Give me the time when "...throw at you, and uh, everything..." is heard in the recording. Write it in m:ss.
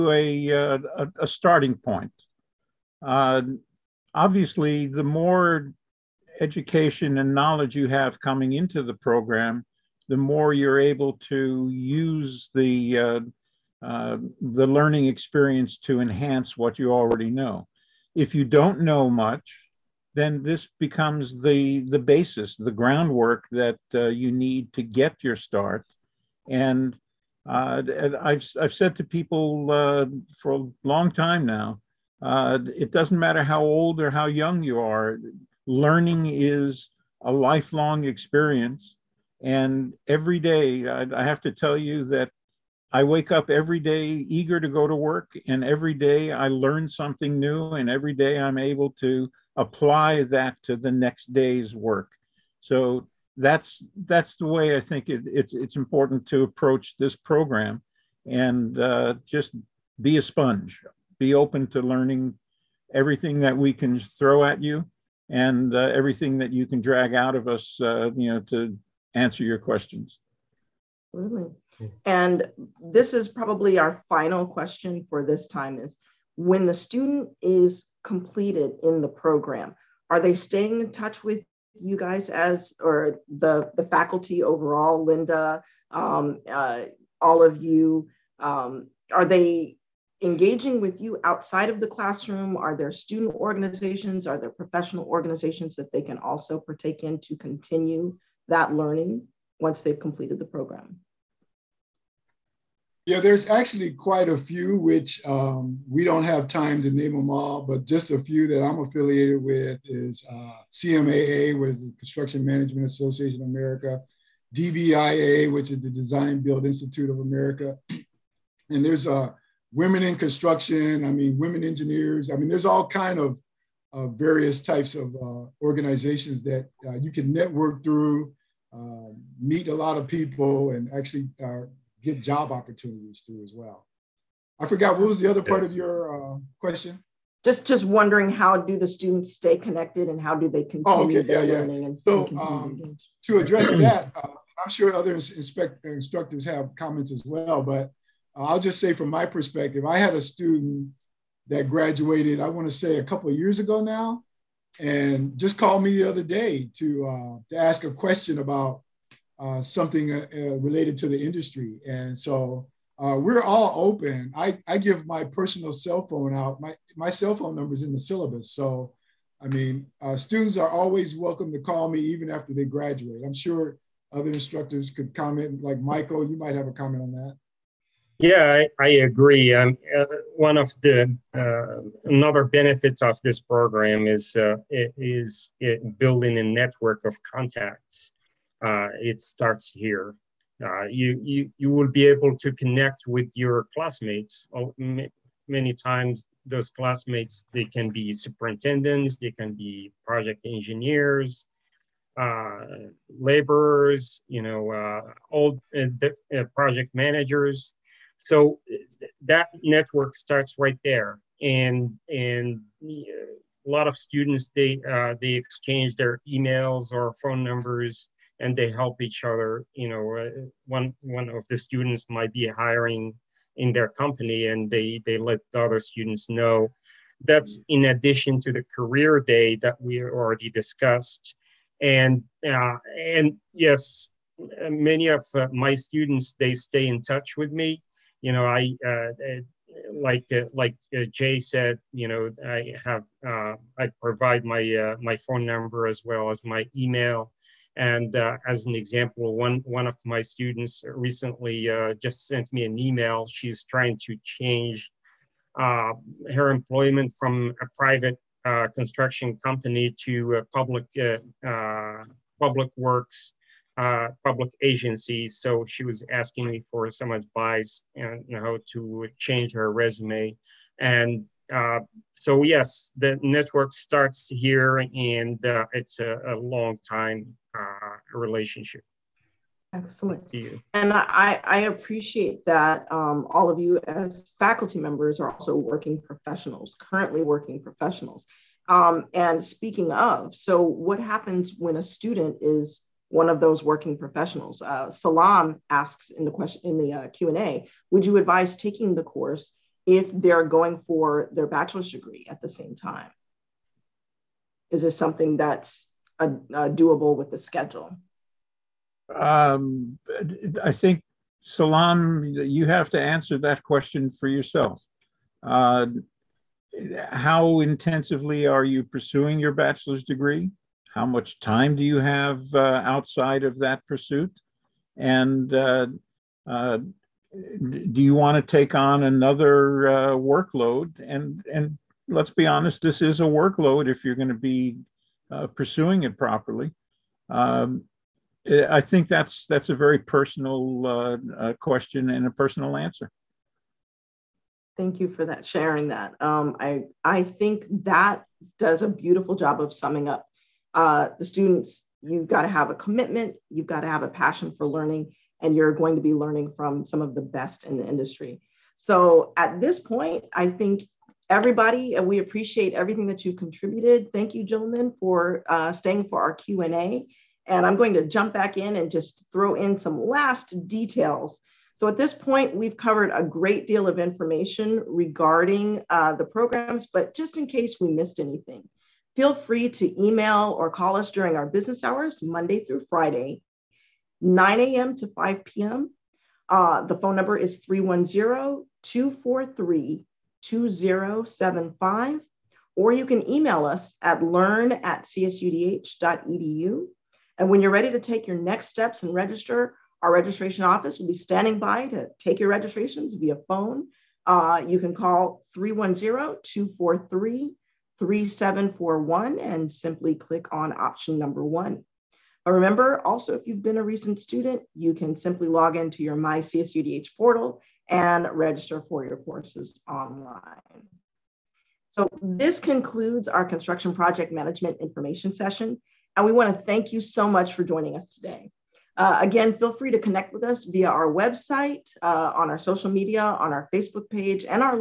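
1:03.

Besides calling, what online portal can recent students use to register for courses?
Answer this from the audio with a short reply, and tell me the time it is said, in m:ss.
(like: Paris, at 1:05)
My CSUDH, at 6:56.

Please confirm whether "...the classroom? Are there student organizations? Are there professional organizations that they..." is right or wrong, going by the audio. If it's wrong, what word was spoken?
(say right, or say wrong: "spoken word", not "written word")
right.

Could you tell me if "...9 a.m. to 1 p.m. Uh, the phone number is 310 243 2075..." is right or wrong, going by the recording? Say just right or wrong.
wrong.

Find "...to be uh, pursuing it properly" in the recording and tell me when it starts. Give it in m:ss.
5:34.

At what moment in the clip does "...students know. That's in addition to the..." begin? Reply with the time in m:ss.
3:45.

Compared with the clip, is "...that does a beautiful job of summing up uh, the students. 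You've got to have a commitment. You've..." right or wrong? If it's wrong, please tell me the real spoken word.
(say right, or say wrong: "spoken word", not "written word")
right.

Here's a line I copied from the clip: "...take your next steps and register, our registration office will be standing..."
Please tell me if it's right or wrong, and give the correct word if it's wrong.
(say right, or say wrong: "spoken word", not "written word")
right.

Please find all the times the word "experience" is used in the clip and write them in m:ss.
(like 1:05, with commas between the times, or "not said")
0:15, 0:38.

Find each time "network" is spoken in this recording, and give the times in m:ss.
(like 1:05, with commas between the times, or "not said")
2:07, 3:06, 3:29, 4:33.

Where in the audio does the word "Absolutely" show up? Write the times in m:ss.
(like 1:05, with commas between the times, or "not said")
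1:11.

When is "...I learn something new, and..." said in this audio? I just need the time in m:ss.
0:46.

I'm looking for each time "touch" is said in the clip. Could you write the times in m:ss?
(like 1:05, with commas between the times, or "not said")
1:20, 3:57.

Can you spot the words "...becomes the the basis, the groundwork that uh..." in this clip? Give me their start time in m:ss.
0:20.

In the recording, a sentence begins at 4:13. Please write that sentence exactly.
She's trying to change uh, her employment from a private uh, construction company to a public, uh, uh, public works, public agency.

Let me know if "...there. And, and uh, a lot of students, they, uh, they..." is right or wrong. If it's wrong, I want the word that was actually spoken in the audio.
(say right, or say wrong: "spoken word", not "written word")
right.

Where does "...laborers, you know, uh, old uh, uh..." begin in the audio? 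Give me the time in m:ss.
3:23.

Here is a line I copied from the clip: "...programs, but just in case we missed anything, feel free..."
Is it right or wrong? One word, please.
right.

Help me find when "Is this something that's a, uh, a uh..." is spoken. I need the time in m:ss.
5:04.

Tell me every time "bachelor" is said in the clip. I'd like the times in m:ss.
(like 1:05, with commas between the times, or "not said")
5:01, 5:19.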